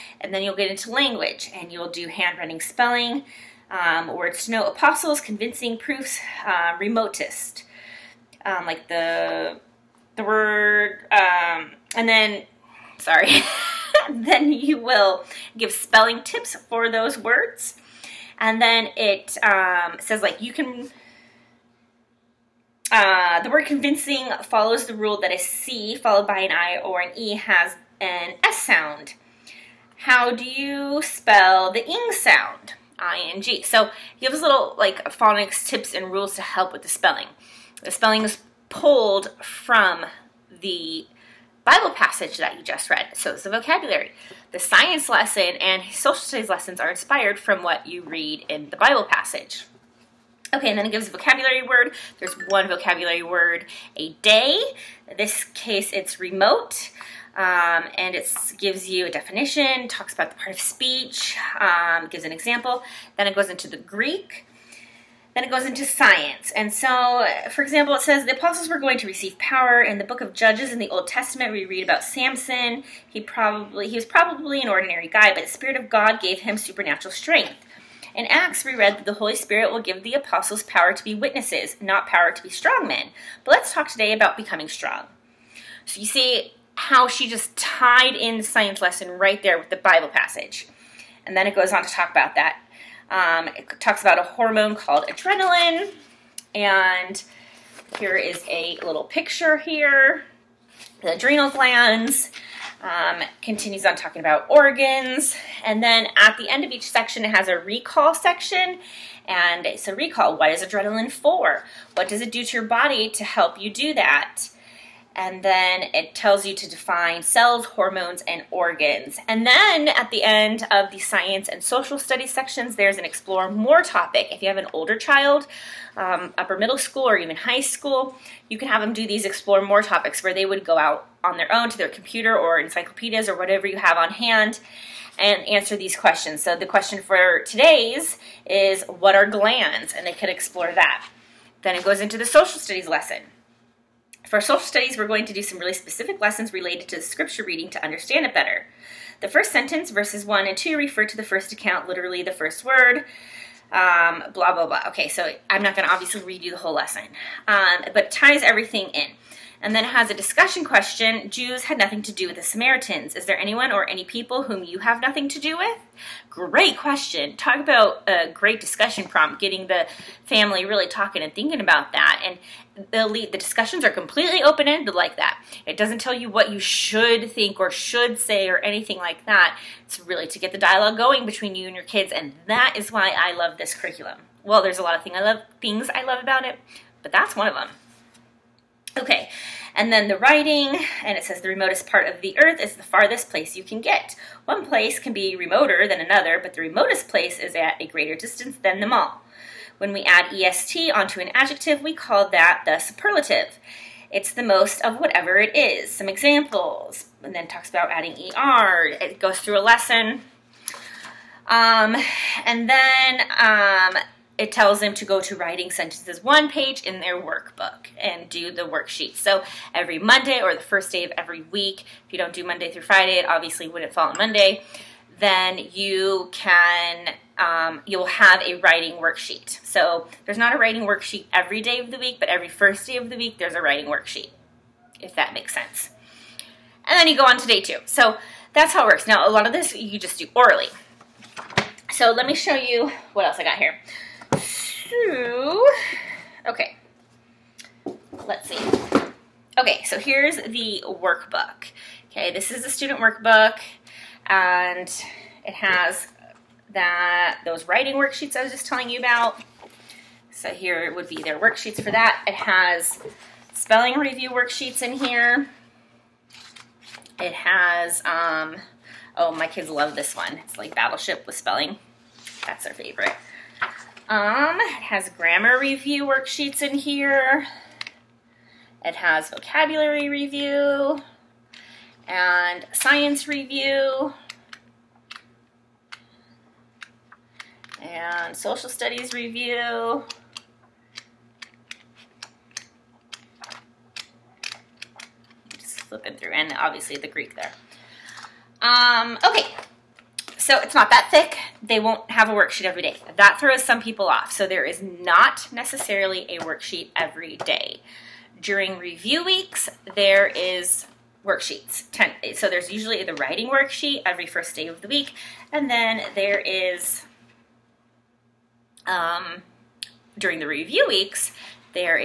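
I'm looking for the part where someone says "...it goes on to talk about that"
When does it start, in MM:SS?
01:31.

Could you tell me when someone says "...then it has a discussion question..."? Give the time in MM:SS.
02:39.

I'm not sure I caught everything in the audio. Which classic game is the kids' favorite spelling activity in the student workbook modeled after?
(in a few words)
Battleship.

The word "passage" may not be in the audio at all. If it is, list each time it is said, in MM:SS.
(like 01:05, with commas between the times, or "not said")
00:41, 00:49, 01:30.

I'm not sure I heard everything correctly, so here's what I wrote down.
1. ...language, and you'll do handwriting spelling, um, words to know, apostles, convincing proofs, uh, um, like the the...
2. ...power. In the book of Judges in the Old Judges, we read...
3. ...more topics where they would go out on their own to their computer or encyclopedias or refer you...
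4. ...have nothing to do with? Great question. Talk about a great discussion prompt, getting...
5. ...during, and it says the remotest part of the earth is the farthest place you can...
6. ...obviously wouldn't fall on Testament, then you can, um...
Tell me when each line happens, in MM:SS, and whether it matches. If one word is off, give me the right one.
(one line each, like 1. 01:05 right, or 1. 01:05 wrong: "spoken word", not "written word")
1. 00:00 right
2. 01:09 wrong: "Testament", not "Judges"
3. 02:09 wrong: "whatever", not "refer"
4. 02:44 right
5. 03:10 wrong: "writing", not "during"
6. 03:43 wrong: "Monday", not "Testament".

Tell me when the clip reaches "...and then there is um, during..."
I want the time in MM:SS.
05:15.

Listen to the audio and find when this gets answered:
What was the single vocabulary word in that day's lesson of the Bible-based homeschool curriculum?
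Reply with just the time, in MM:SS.
00:56.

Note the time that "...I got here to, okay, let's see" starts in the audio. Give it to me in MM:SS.
04:03.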